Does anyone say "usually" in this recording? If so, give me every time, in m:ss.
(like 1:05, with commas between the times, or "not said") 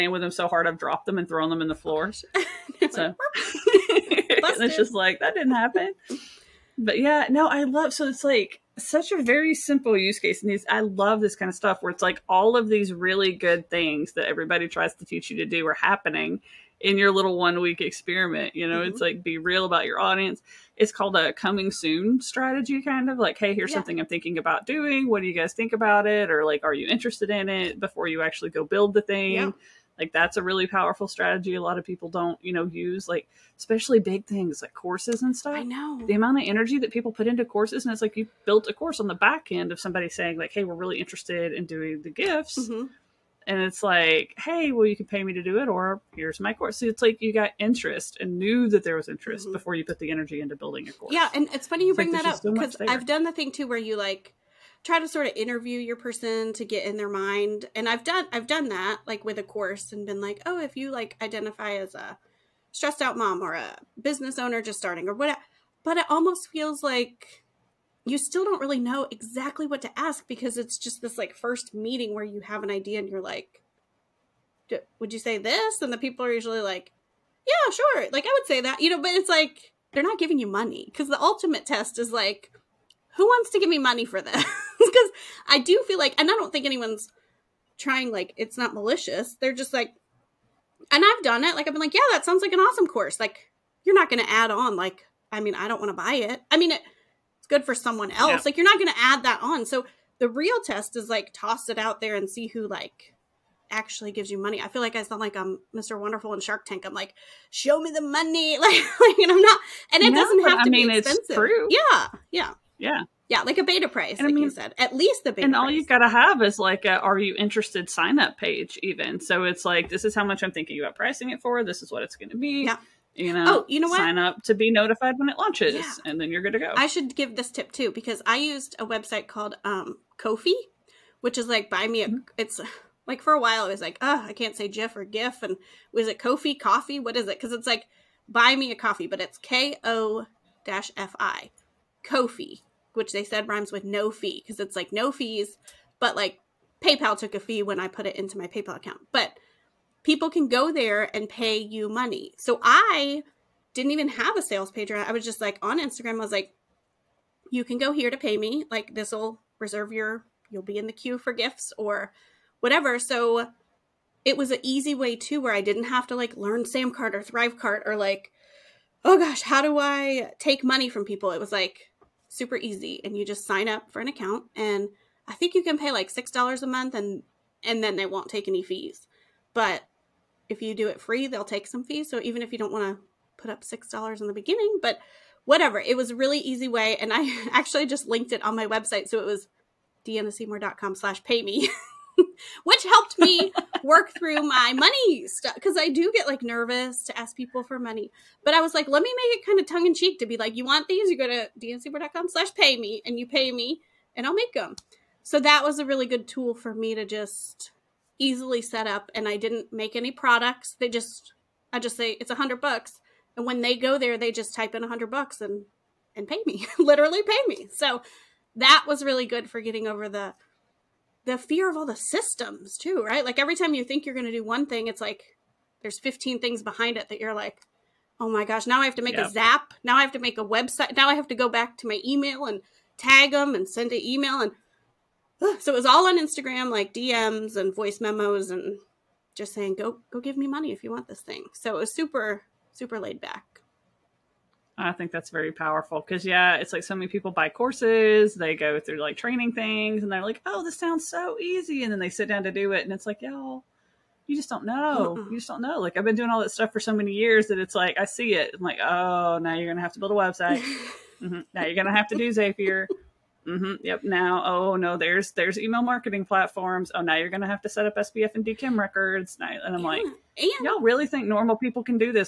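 1:16.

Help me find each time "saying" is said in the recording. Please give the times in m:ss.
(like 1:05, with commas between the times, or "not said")
0:40, 3:59.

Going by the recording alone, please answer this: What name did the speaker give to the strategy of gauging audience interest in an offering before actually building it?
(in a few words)
coming soon strategy.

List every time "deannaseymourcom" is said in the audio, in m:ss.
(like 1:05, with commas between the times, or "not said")
3:10, 3:21.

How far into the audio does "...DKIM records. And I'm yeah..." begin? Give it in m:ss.
4:28.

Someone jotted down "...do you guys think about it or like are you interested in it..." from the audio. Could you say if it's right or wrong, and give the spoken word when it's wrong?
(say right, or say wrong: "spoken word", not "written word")
right.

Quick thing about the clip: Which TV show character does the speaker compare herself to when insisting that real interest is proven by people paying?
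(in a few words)
Mr. Wonderful.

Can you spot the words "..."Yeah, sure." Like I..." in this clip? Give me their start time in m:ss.
1:17.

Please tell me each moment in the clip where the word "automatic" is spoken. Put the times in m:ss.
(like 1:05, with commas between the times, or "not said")
not said.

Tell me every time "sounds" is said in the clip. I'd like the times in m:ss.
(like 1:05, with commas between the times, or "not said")
1:32, 1:45, 4:10.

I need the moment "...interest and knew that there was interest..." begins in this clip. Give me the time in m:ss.
0:47.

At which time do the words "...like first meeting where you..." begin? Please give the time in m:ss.
1:11.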